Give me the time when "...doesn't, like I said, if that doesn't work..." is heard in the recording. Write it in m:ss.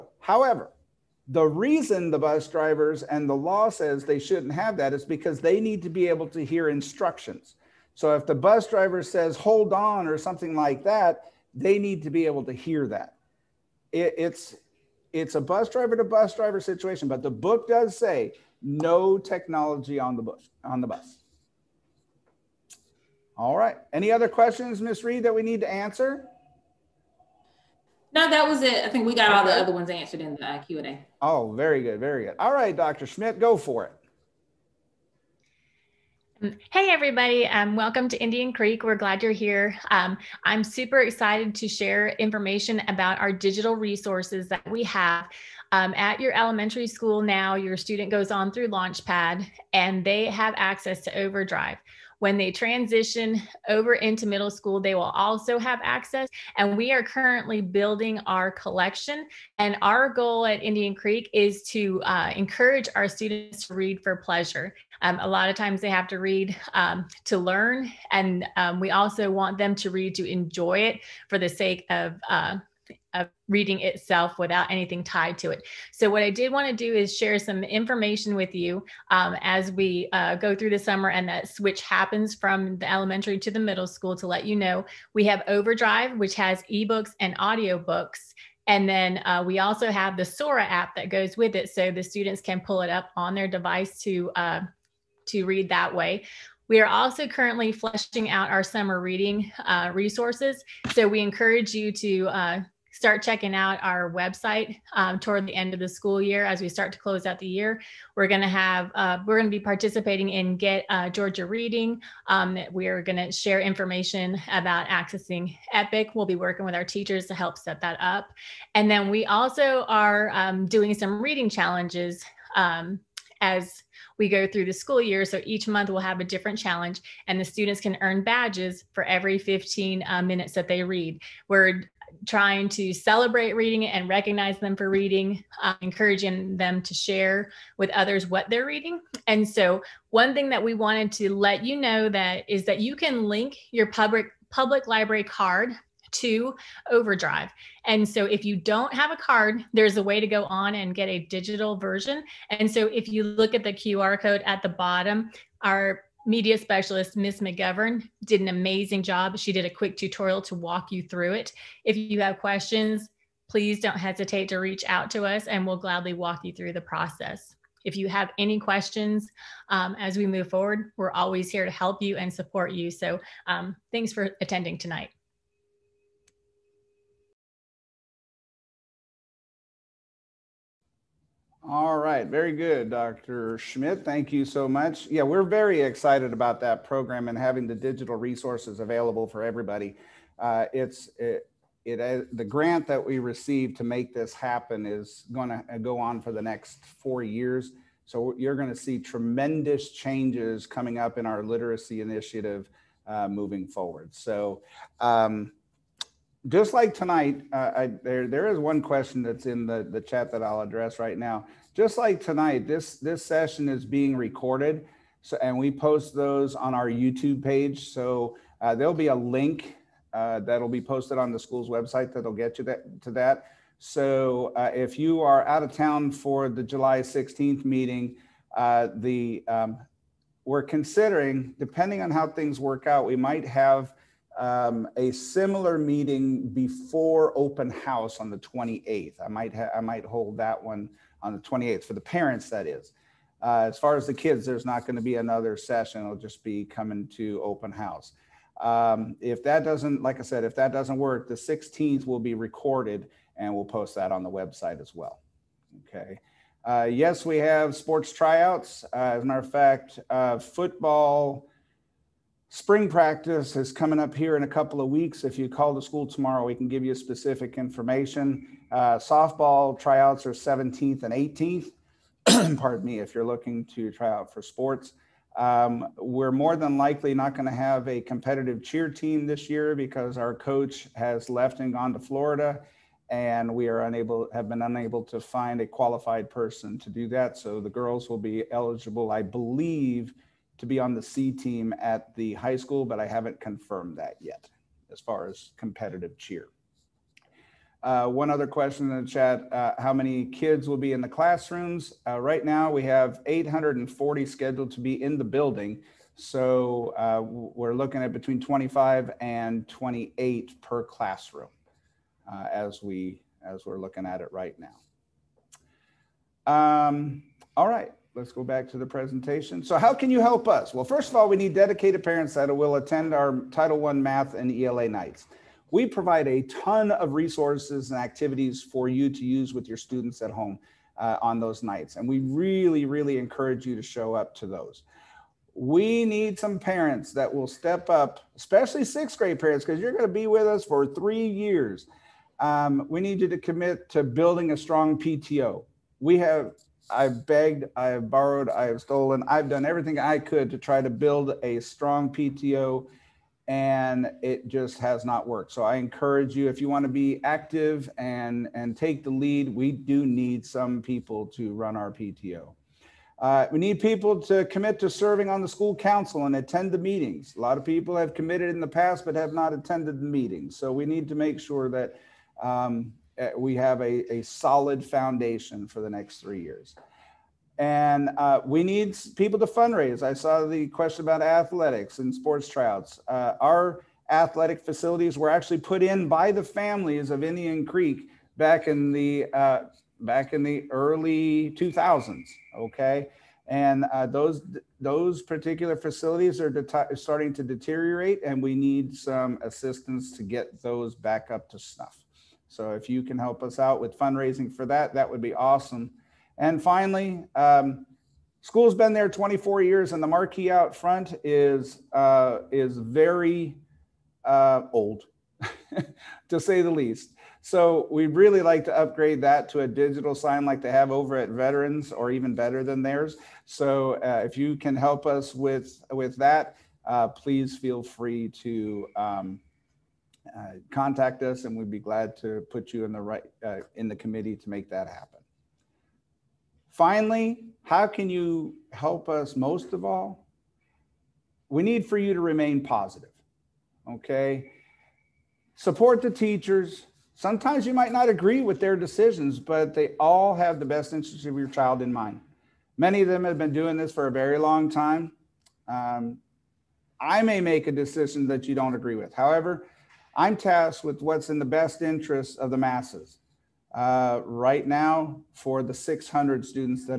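4:09.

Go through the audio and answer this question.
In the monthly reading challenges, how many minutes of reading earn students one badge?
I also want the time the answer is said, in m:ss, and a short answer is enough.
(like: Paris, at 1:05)
15, at 2:09.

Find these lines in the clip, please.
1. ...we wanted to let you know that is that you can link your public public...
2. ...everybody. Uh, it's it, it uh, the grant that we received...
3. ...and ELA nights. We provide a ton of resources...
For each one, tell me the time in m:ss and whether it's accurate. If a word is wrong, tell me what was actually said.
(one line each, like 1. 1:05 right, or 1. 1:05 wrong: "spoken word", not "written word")
1. 2:20 right
2. 3:09 right
3. 5:24 right.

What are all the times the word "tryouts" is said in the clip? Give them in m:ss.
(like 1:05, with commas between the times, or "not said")
4:18, 4:29, 6:22.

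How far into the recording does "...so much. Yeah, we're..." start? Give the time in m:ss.
3:04.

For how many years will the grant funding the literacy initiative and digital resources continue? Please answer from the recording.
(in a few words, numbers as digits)
4.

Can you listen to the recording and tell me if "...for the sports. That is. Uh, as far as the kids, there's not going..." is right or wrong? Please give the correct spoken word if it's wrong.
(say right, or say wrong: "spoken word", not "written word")
wrong: "parents", not "sports".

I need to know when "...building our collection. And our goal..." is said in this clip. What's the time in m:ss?
0:57.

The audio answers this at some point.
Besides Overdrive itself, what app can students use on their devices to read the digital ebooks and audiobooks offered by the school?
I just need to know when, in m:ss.
1:30.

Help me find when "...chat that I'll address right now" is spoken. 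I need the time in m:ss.
3:30.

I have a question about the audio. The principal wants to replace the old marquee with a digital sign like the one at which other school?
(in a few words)
Veterans.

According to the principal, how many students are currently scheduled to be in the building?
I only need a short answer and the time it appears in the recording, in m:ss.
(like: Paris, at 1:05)
840, at 5:03.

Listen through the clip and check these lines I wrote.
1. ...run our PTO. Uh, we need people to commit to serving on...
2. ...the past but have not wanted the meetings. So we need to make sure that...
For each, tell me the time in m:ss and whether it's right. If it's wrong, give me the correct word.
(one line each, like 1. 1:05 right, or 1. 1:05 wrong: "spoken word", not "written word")
1. 6:01 right
2. 6:08 wrong: "attended", not "wanted".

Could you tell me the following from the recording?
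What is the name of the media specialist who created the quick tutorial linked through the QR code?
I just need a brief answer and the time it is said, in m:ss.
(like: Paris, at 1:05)
Miss McGovern, at 2:37.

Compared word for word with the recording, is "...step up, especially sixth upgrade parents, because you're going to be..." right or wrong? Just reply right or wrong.
wrong.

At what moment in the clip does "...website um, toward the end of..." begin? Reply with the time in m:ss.
1:44.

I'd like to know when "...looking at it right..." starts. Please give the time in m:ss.
5:13.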